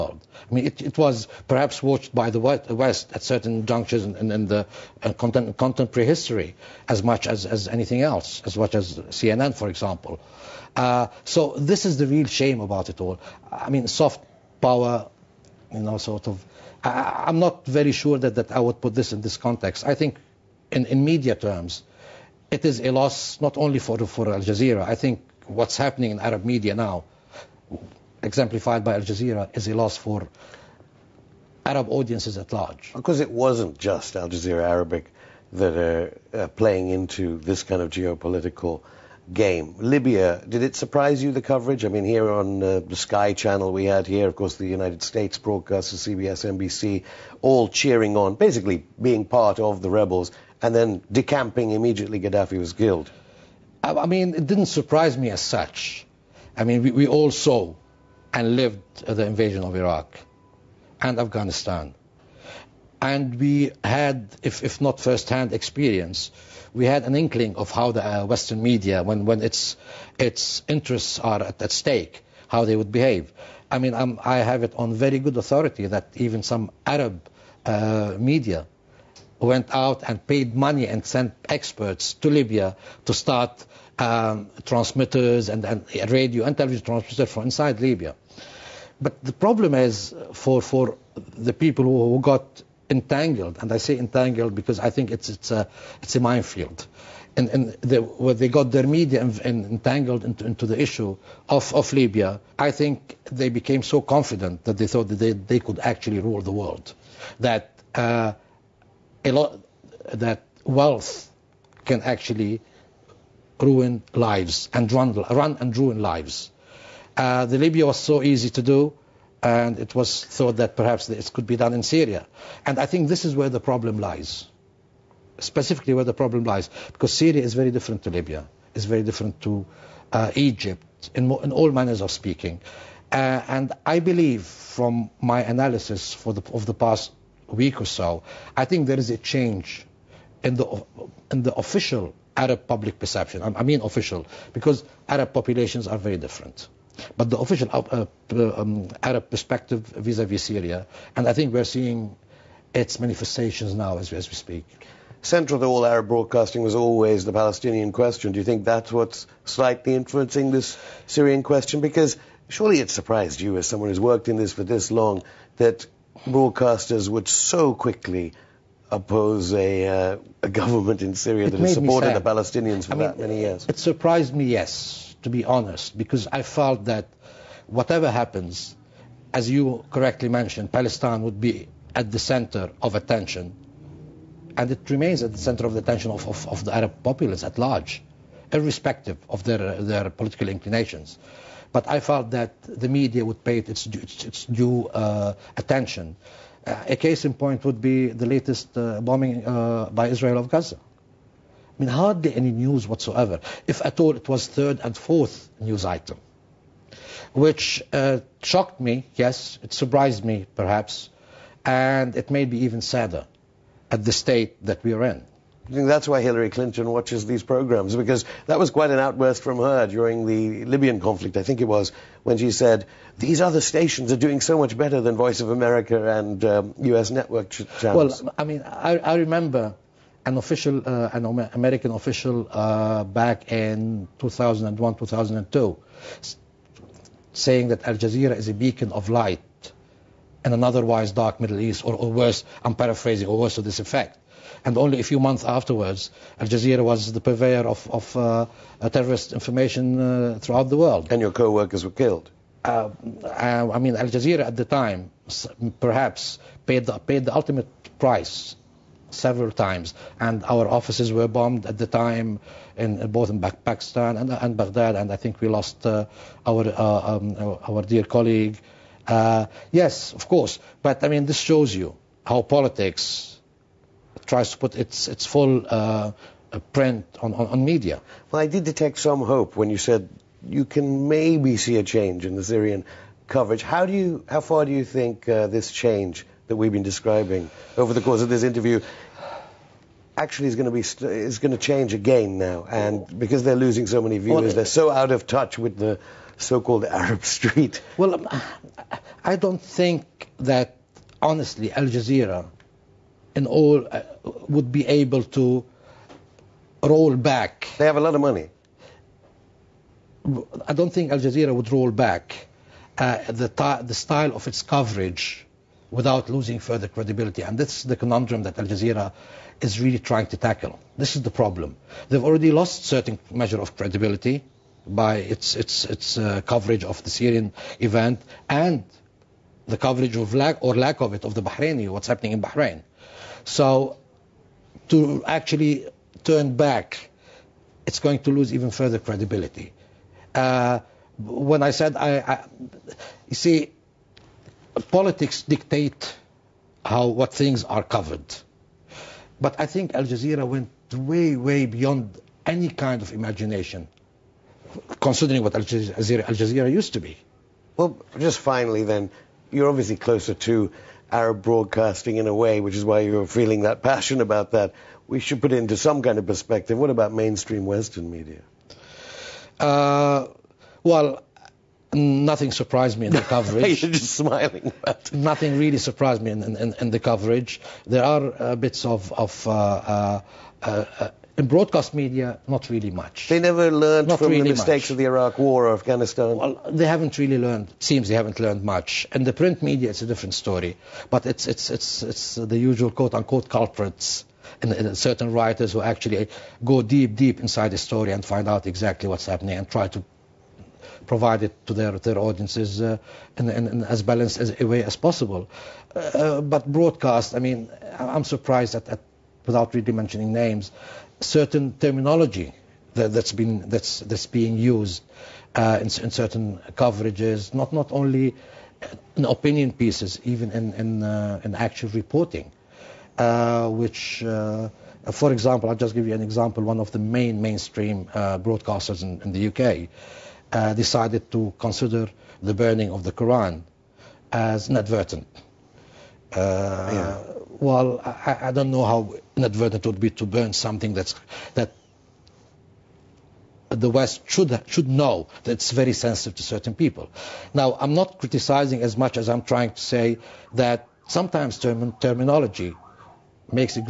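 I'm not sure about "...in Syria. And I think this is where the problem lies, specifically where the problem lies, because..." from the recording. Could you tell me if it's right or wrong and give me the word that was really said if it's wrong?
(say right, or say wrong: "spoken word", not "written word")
right.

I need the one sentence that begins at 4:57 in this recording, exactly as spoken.
Well, um, I don't think that honestly Al Jazeera, in all, uh, would be able to roll back.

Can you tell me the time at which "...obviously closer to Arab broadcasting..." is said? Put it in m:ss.
5:59.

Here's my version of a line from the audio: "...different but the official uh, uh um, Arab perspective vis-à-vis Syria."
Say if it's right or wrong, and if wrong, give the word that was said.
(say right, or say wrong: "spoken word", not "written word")
right.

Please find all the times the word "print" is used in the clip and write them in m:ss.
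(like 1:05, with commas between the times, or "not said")
4:36, 6:29.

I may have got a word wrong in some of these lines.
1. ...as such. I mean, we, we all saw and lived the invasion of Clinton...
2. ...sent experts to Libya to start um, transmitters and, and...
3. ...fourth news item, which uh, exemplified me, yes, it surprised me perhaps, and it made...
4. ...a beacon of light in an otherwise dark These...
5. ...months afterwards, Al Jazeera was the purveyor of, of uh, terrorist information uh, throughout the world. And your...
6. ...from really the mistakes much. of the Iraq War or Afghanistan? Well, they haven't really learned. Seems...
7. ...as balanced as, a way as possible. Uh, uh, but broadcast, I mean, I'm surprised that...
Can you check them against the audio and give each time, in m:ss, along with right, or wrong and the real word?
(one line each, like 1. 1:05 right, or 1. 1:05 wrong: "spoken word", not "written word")
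1. 0:55 wrong: "Iraq", not "Clinton"
2. 1:21 right
3. 3:24 wrong: "shocked", not "exemplified"
4. 3:58 wrong: "Middle", not "These"
5. 4:05 right
6. 6:24 right
7. 6:43 right.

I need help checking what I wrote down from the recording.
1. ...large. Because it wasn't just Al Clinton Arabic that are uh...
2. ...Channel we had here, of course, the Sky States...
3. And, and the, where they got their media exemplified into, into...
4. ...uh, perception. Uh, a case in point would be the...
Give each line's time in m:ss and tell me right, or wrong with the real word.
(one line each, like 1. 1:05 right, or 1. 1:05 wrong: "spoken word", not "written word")
1. 0:32 wrong: "Jazeera", not "Clinton"
2. 0:43 wrong: "United", not "Sky"
3. 1:37 wrong: "entangled", not "exemplified"
4. 3:14 wrong: "attention", not "perception".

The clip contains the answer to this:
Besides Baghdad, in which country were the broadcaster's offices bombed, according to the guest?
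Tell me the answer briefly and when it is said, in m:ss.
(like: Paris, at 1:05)
Pakistan, at 4:23.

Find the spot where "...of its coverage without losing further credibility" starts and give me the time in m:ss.
5:14.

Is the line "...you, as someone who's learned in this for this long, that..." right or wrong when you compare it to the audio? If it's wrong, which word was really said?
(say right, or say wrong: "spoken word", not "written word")
wrong: "worked", not "learned".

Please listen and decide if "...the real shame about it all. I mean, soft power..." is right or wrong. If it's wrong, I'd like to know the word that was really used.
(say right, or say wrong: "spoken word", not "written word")
right.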